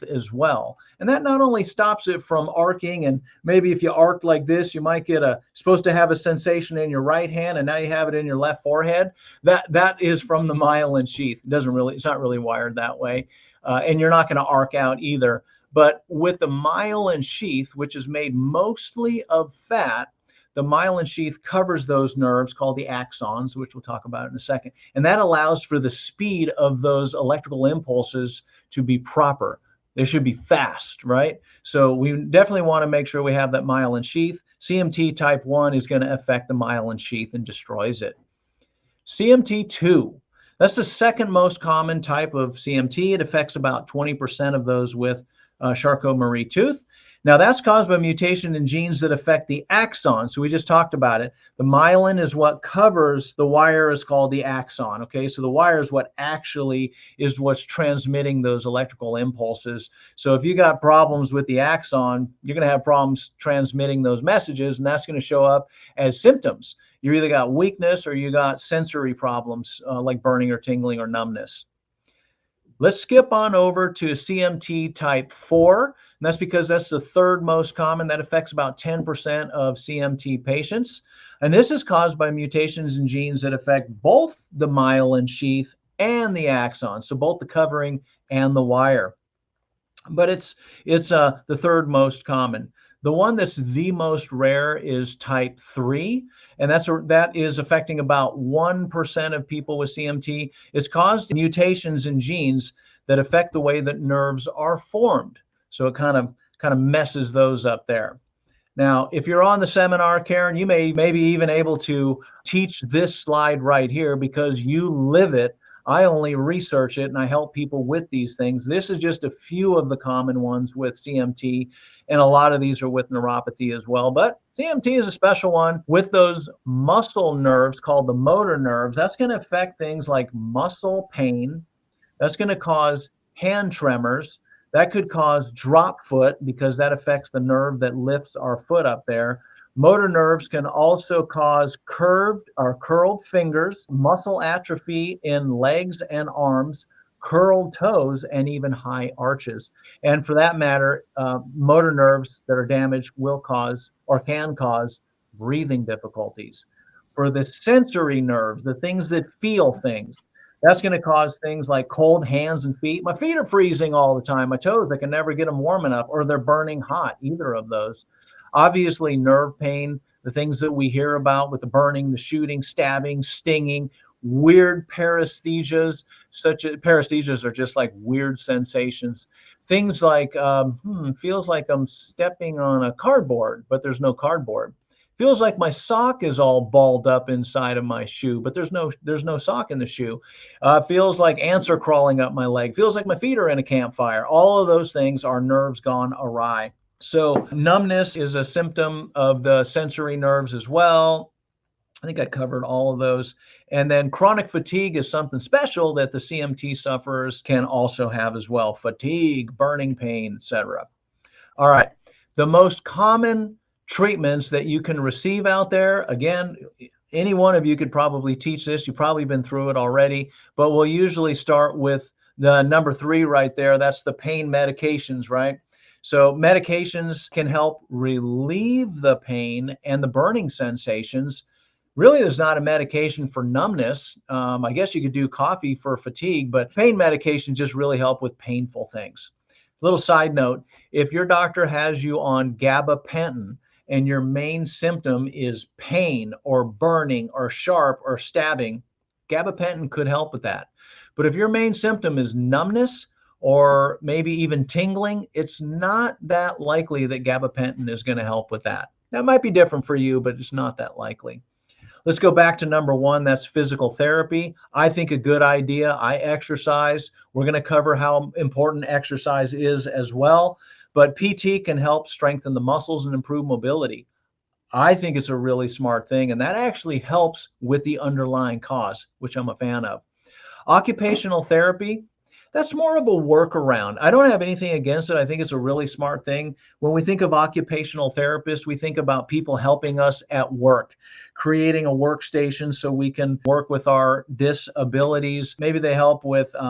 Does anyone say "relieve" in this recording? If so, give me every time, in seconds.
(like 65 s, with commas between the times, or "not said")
227 s.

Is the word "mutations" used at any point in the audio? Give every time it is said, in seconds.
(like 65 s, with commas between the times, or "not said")
47 s, 82 s, 101 s.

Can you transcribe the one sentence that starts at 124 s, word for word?
But CMT is a special one with those muscle nerves called the motor nerves.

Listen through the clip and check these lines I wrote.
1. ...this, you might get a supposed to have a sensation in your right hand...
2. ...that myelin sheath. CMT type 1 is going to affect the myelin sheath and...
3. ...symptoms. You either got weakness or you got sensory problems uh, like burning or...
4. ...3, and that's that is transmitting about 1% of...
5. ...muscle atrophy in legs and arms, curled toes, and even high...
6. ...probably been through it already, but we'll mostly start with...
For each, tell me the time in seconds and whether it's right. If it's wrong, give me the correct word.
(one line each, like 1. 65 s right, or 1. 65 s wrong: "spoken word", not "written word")
1. 4 s right
2. 33 s right
3. 66 s right
4. 95 s wrong: "affecting", not "transmitting"
5. 143 s right
6. 218 s wrong: "usually", not "mostly".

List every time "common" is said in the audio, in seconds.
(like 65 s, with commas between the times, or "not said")
41 s, 77 s, 92 s, 119 s, 212 s.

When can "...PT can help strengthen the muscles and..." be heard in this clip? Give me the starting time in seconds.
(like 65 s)
271 s.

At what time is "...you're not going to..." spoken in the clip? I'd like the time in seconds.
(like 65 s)
13 s.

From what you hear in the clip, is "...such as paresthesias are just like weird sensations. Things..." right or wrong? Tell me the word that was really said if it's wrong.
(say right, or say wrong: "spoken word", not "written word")
right.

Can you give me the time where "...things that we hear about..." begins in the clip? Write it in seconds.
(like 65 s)
170 s.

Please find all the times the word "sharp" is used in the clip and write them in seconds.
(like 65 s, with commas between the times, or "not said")
247 s.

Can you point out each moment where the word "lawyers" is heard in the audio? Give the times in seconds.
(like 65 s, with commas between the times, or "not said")
not said.